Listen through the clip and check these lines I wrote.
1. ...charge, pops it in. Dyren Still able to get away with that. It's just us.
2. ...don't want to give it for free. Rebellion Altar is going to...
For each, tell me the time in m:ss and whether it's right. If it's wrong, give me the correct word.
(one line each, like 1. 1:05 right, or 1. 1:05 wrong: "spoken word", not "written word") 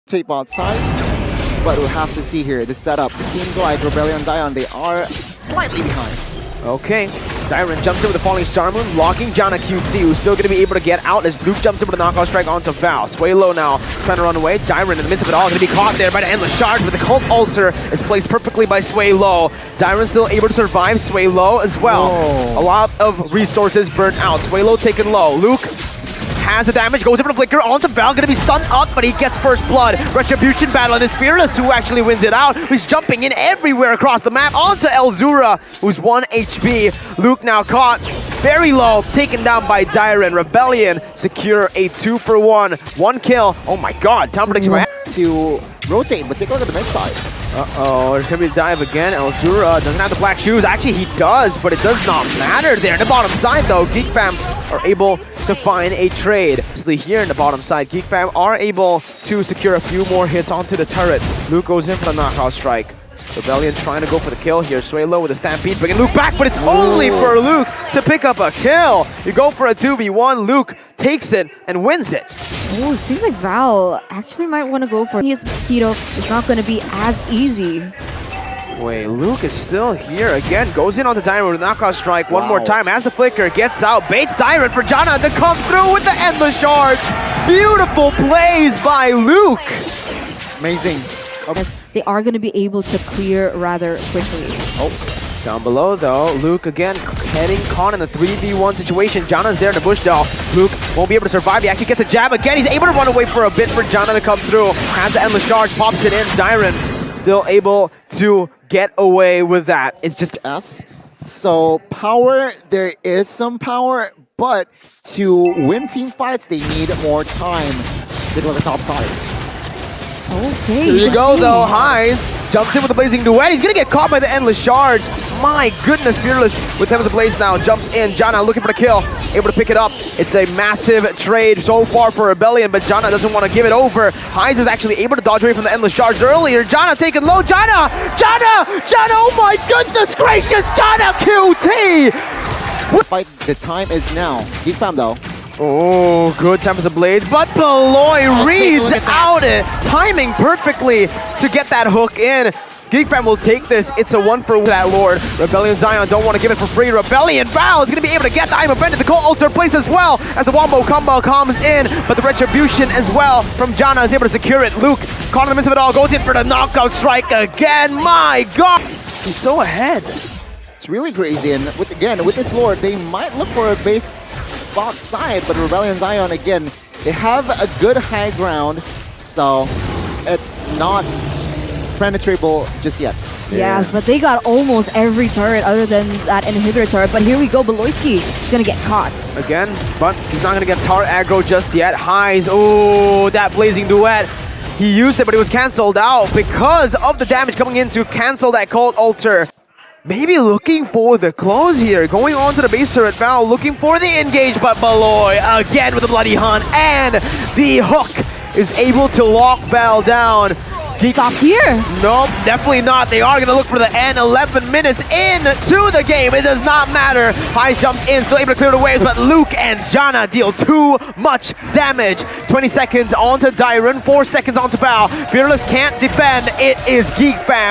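1. 1:45 right
2. 2:36 wrong: "Val", not "Altar".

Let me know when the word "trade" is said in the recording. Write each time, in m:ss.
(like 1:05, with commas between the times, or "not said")
0:56, 2:11.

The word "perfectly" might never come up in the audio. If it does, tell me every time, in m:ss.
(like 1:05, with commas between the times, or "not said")
0:18, 2:30.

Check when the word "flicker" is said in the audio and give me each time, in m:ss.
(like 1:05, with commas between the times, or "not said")
0:27, 1:23.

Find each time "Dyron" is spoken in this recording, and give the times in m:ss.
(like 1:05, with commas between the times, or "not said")
0:07, 0:14, 0:19, 1:24, 3:43.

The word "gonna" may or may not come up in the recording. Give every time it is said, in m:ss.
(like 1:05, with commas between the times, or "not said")
0:28, 0:48.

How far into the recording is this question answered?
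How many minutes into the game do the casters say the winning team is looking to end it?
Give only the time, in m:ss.
3:34.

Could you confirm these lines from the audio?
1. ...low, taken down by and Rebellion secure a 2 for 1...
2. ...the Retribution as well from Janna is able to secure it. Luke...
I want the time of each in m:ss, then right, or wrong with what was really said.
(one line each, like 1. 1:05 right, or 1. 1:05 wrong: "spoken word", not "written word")
1. 0:38 right
2. 2:42 right.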